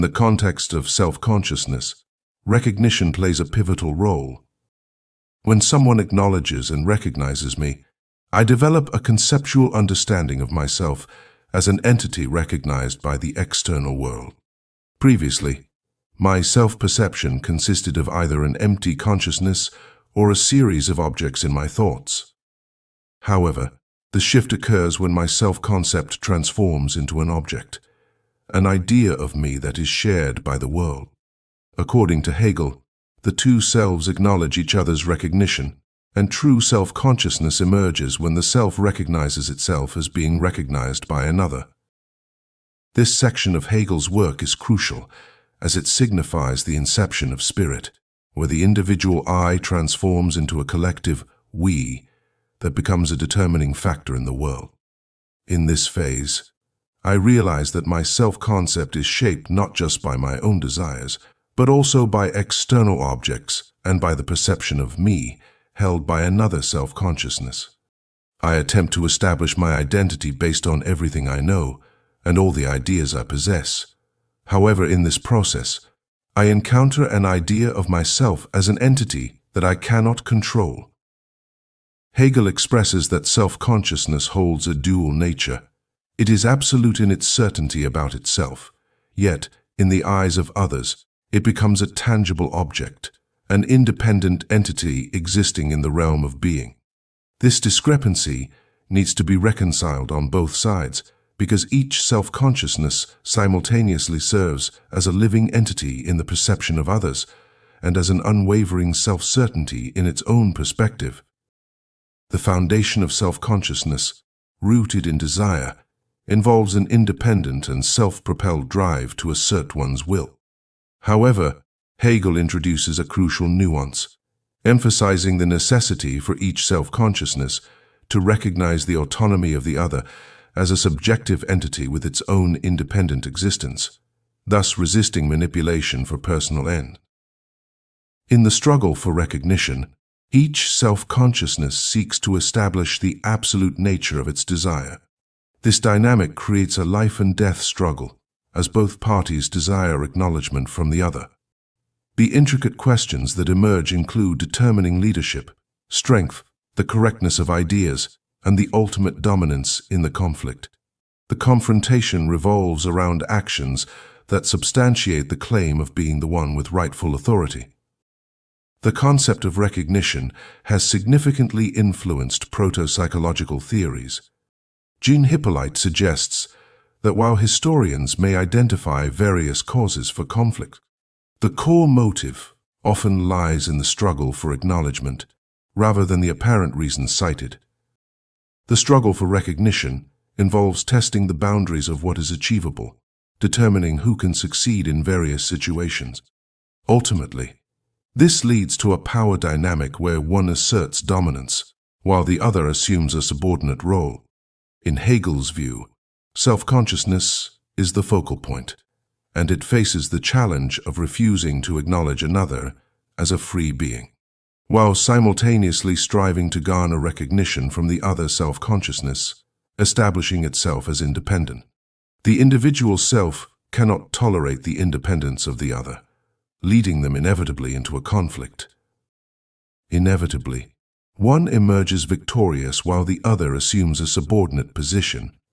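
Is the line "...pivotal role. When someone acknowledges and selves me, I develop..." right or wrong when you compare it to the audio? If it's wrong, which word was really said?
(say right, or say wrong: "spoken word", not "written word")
wrong: "recognizes", not "selves".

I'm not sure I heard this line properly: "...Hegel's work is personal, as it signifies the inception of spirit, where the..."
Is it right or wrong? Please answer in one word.
wrong.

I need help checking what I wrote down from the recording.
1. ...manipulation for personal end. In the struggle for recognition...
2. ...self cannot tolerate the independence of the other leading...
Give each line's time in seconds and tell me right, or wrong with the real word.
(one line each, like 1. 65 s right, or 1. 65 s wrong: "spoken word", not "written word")
1. 135 s right
2. 222 s right.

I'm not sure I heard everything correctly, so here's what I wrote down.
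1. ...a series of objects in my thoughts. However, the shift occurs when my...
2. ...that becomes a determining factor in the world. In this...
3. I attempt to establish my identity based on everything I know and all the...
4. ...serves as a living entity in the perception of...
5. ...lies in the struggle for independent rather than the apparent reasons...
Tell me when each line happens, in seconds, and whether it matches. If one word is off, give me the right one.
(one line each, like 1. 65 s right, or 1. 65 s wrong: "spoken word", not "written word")
1. 20 s right
2. 52 s right
3. 68 s right
4. 104 s right
5. 183 s wrong: "acknowledgement", not "independent".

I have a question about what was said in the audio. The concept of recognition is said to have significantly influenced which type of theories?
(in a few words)
proto-psychological theories.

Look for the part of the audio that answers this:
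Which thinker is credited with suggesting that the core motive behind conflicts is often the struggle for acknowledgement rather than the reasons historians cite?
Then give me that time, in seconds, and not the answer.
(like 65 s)
174 s.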